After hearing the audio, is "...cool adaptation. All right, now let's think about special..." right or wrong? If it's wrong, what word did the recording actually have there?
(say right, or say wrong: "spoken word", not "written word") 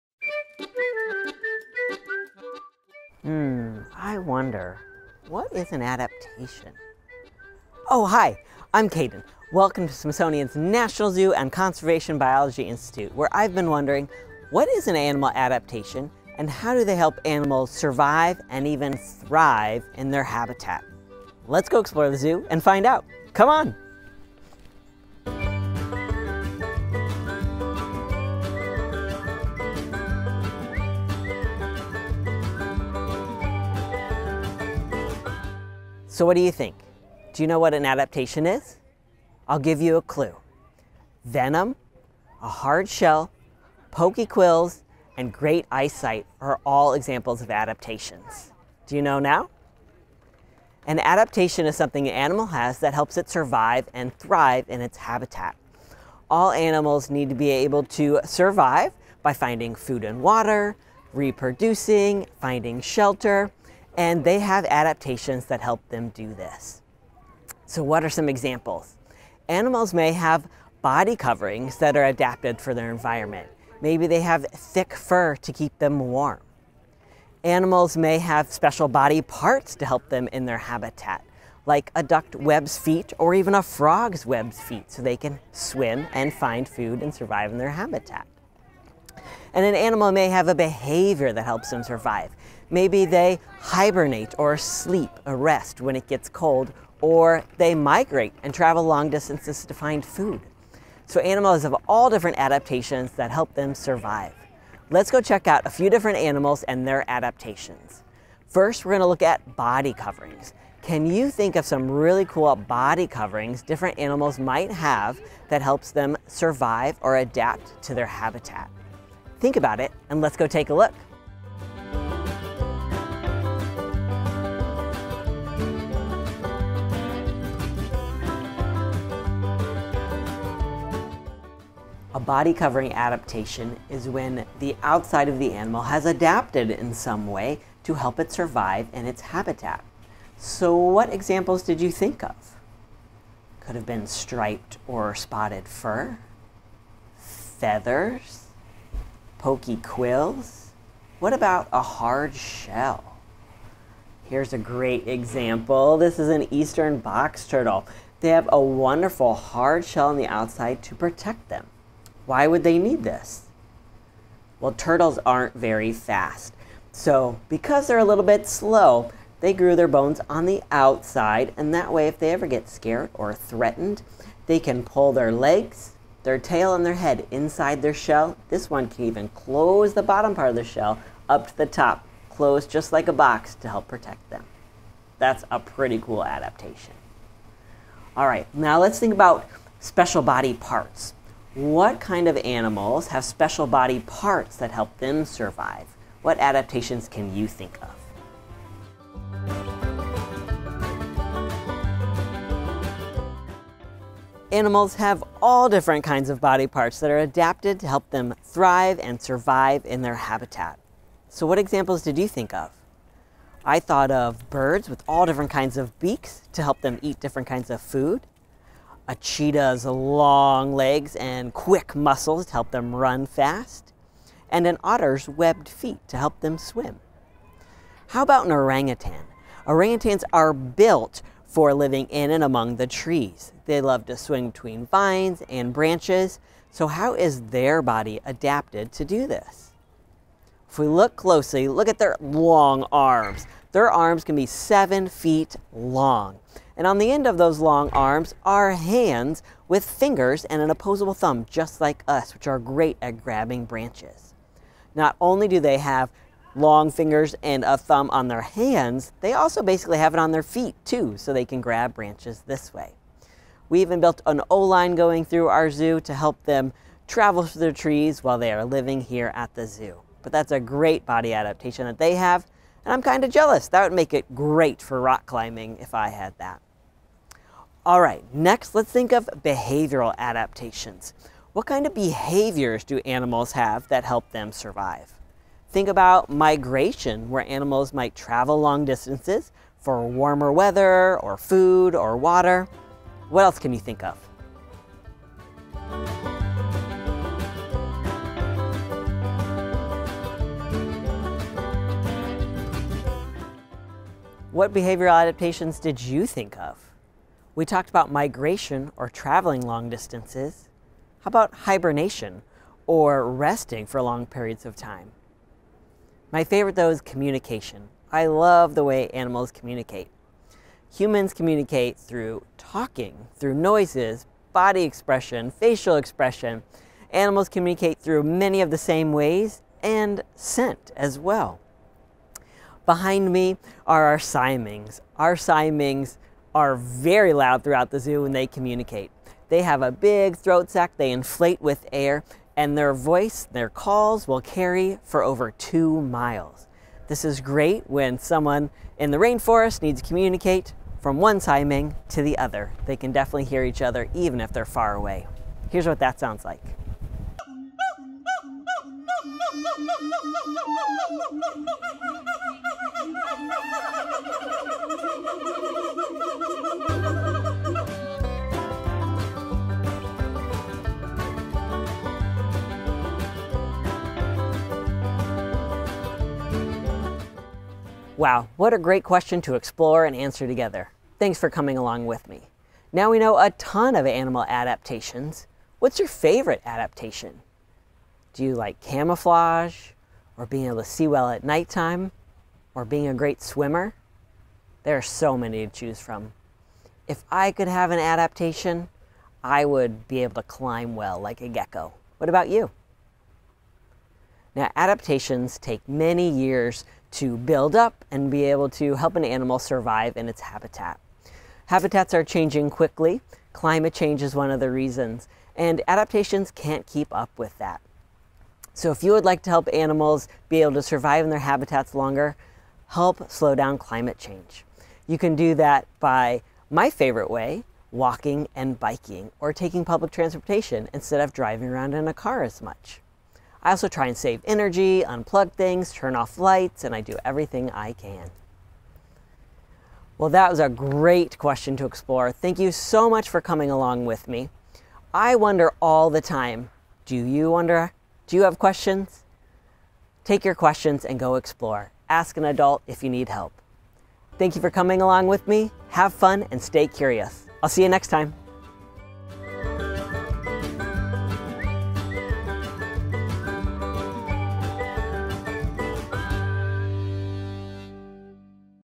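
right.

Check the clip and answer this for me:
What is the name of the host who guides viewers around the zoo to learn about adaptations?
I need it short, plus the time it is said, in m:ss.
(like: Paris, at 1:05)
Kaden, at 0:08.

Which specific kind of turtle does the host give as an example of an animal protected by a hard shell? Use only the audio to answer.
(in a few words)
Eastern box turtle.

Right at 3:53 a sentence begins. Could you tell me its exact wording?
They love to swing between vines and branches.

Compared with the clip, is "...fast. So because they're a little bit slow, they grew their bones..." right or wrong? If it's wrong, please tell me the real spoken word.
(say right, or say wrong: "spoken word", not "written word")
right.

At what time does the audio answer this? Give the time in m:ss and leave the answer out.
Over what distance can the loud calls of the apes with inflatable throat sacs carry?
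5:45.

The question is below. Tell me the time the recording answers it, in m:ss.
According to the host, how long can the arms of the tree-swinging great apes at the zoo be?
4:04.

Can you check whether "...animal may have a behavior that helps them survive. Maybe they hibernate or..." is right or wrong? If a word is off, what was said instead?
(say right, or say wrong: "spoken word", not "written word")
right.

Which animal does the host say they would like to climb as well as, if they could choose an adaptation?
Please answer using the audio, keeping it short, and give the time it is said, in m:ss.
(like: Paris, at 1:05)
Gecko, at 6:41.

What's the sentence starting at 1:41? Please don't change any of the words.
So animals have all different adaptations that help them survive.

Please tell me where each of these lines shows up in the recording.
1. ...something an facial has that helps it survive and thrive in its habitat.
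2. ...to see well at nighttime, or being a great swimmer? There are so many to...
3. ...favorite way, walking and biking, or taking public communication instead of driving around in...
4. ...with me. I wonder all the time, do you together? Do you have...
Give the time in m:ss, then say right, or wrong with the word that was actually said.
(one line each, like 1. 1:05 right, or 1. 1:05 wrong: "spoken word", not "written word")
1. 0:51 wrong: "animal", not "facial"
2. 6:30 right
3. 7:06 wrong: "transportation", not "communication"
4. 7:24 wrong: "wonder", not "together".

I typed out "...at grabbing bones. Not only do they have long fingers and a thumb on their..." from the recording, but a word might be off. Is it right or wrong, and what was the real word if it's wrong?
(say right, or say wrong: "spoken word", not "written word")
wrong: "branches", not "bones".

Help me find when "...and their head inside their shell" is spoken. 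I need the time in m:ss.
2:56.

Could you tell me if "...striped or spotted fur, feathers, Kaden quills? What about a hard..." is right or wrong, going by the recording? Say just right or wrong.
wrong.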